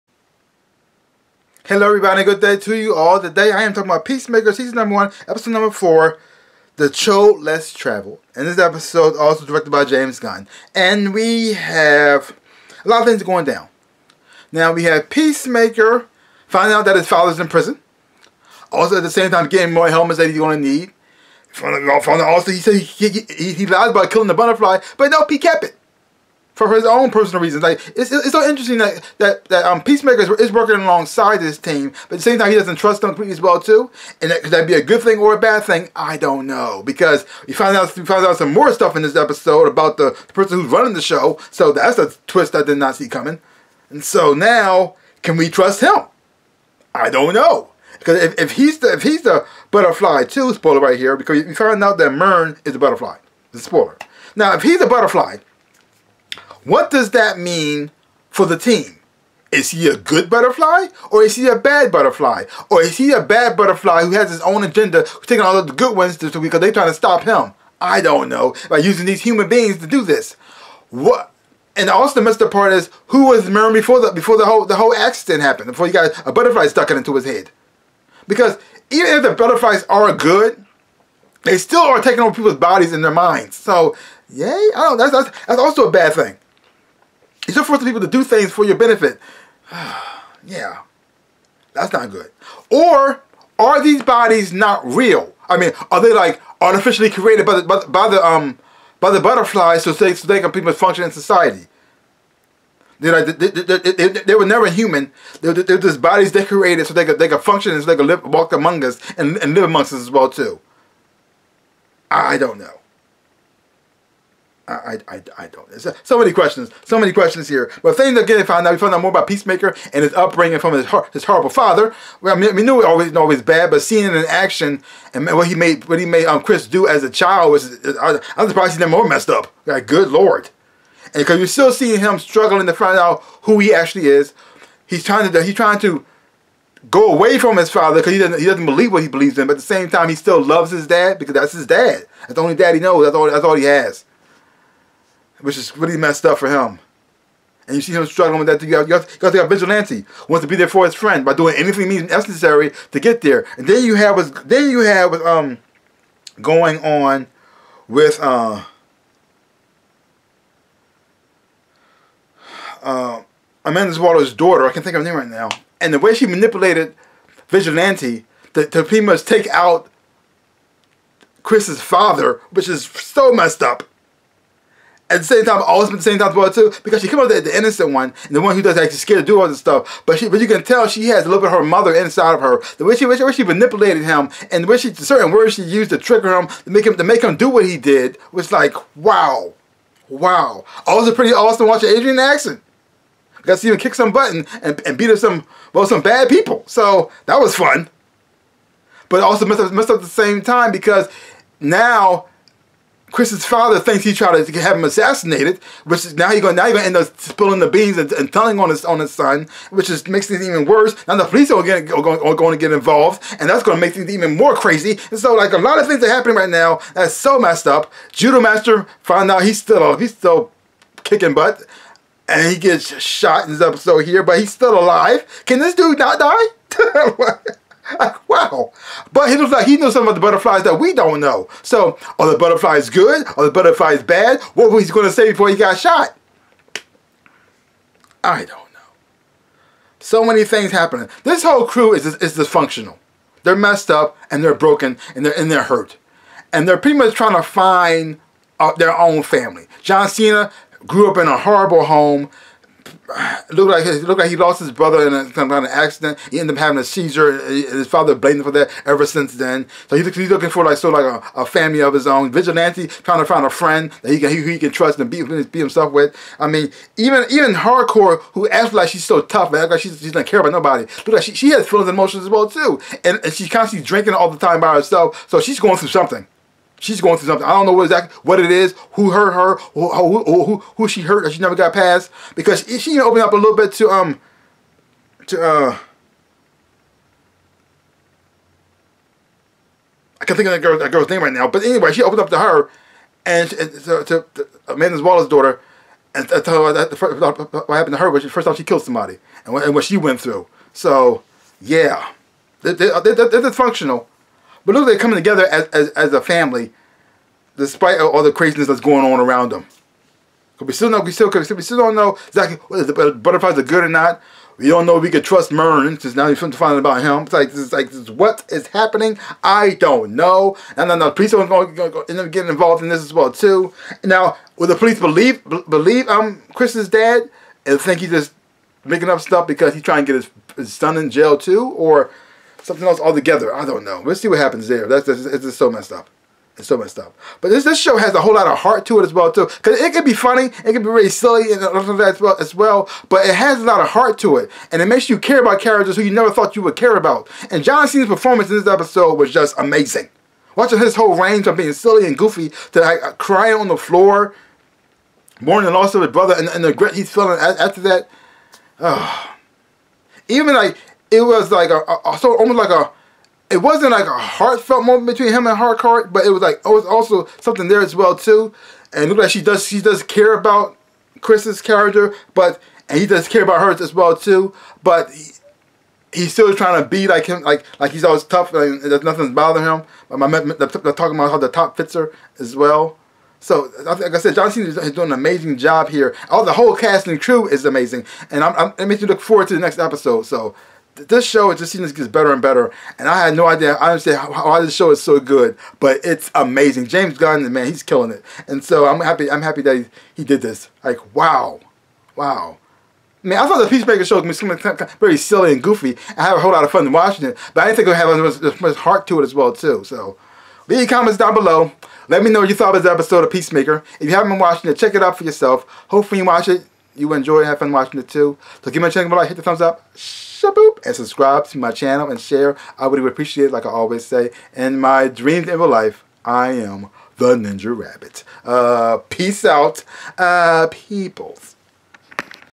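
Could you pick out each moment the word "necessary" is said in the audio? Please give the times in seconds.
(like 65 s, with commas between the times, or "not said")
152 s.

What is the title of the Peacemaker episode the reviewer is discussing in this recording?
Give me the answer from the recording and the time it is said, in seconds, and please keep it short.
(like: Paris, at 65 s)
The Choad Less Travel, at 6 s.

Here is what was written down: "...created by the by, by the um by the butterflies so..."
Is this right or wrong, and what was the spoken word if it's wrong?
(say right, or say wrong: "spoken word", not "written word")
right.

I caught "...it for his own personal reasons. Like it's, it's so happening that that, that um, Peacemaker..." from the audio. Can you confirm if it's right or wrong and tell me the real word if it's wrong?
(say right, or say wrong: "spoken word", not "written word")
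wrong: "interesting", not "happening".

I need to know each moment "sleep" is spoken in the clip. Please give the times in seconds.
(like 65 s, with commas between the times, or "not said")
not said.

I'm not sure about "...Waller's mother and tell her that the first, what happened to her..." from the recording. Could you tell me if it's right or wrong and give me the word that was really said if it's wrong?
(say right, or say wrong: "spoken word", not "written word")
wrong: "daughter", not "mother".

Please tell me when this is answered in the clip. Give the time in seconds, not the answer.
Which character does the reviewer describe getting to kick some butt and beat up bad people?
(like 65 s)
191 s.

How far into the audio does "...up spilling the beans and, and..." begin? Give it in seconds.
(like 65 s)
206 s.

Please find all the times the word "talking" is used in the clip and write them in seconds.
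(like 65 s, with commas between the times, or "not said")
3 s, 380 s.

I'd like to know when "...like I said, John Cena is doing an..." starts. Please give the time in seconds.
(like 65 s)
383 s.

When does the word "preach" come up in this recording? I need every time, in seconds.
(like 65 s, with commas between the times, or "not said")
not said.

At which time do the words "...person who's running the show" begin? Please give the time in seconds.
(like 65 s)
40 s.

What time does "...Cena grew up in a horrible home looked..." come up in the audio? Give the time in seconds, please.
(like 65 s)
250 s.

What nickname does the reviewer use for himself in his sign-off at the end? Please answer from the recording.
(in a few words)
Ninja Rabbit.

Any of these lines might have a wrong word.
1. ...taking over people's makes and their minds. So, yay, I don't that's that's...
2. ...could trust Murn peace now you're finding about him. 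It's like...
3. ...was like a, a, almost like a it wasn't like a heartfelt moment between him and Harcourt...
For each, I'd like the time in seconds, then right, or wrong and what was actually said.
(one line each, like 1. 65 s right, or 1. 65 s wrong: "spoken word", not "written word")
1. 82 s wrong: "bodies", not "makes"
2. 315 s wrong: "since", not "peace"
3. 361 s right.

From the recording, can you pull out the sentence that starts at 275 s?
So she's going through something she's going through something.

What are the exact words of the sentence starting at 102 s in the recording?
They're like, they, they, they, they, were never human.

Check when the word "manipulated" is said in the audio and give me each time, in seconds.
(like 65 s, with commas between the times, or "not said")
166 s, 183 s.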